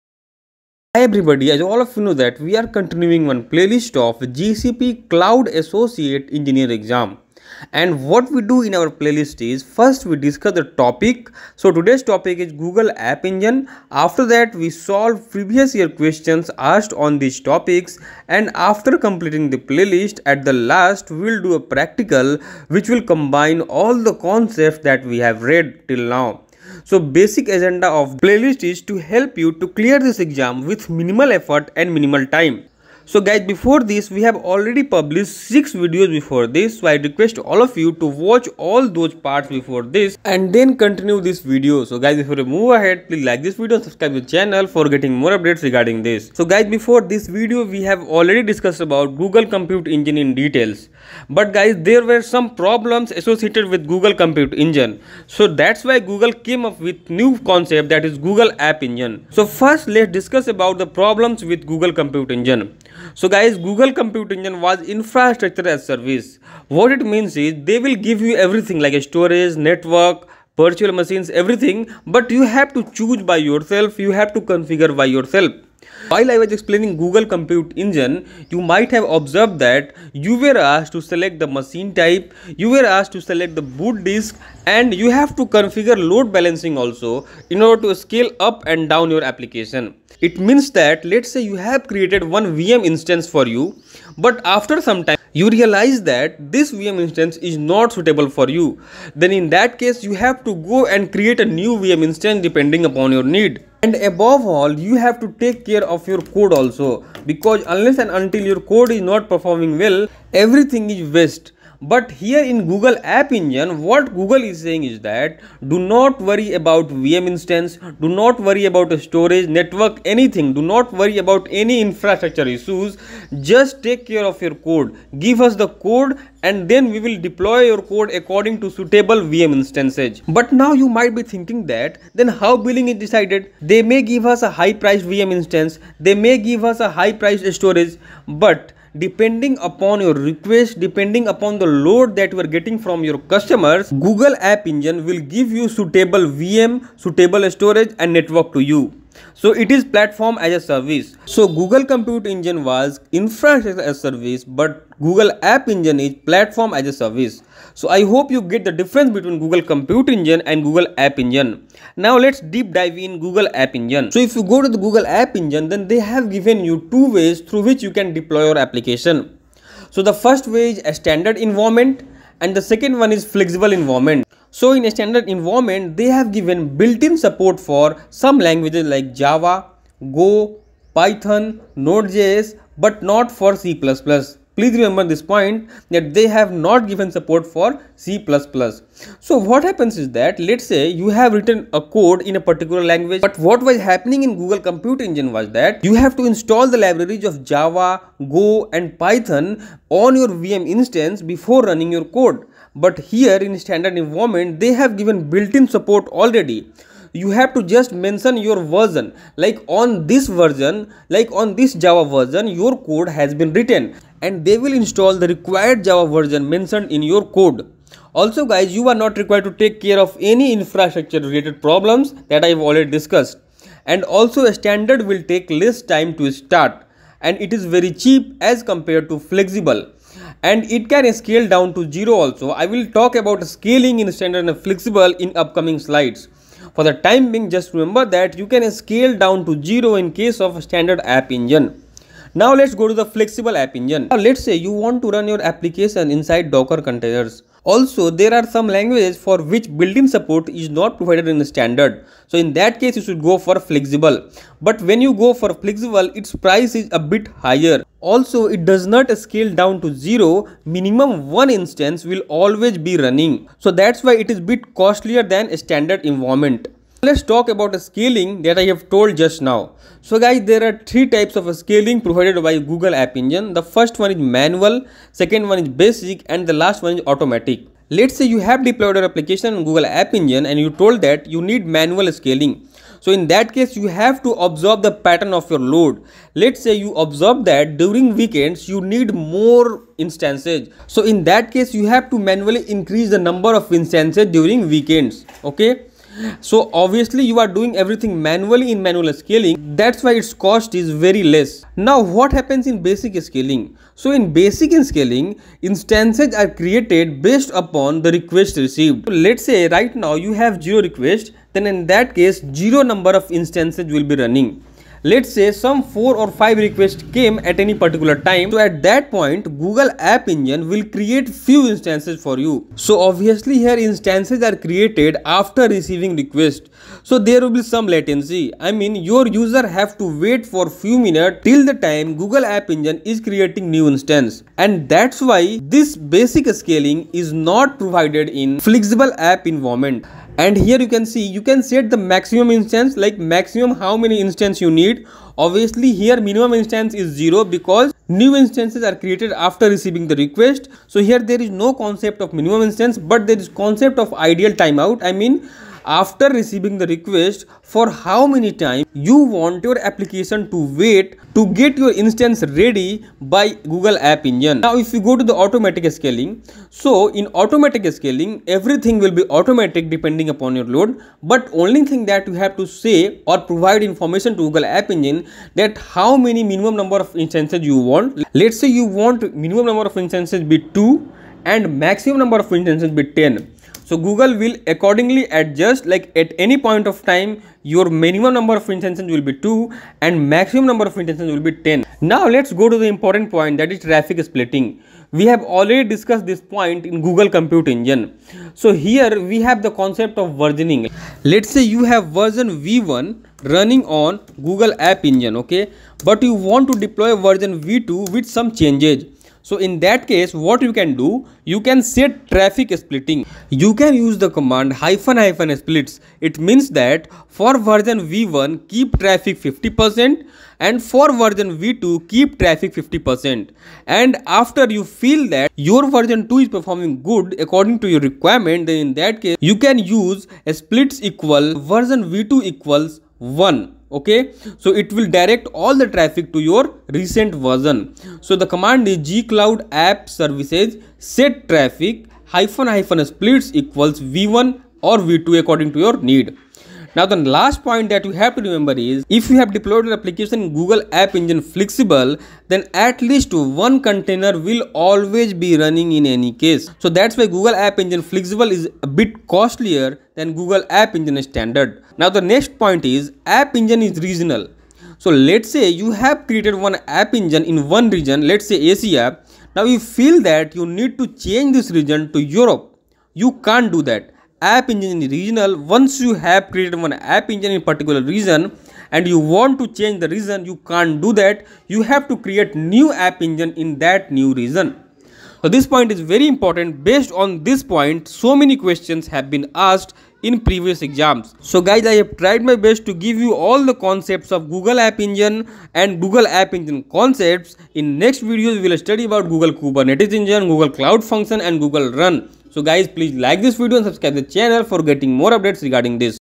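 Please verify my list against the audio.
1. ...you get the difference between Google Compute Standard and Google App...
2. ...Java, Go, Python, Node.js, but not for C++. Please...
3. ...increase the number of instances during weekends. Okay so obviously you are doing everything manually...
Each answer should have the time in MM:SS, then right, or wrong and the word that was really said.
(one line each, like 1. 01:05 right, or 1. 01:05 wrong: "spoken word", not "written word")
1. 02:38 wrong: "Engine", not "Standard"
2. 02:59 right
3. 04:52 right.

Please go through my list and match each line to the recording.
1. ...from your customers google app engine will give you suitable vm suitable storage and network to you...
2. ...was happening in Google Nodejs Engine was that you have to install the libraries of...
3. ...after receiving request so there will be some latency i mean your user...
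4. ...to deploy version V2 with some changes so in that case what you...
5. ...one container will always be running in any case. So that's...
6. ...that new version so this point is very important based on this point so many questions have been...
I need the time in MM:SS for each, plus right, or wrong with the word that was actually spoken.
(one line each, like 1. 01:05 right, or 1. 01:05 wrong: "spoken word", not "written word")
1. 02:22 right
2. 03:13 wrong: "Compute", not "Nodejs"
3. 05:25 right
4. 06:46 right
5. 07:33 right
6. 08:03 wrong: "region", not "version".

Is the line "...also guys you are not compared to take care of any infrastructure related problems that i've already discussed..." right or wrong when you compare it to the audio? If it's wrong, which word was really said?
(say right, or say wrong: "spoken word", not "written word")
wrong: "required", not "compared".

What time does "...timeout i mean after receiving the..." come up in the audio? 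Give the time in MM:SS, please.
05:54.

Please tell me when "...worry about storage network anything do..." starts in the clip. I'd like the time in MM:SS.
01:58.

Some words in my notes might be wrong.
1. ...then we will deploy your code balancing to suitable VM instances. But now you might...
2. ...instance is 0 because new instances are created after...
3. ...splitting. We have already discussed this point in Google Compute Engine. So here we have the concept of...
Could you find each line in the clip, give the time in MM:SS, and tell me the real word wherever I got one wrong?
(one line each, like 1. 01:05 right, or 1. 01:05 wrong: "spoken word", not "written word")
1. 02:06 wrong: "according", not "balancing"
2. 05:46 right
3. 06:34 right.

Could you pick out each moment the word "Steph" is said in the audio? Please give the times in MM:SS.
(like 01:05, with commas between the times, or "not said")
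not said.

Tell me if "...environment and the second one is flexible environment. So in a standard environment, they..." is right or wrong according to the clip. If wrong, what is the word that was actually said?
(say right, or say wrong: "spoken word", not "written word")
right.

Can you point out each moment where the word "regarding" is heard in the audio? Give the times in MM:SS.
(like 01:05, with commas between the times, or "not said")
00:45, 08:25.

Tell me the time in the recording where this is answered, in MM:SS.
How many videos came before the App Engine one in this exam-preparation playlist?
00:35.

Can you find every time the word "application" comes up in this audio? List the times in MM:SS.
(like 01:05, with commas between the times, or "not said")
01:29, 02:48, 04:05, 04:39, 05:59, 07:29.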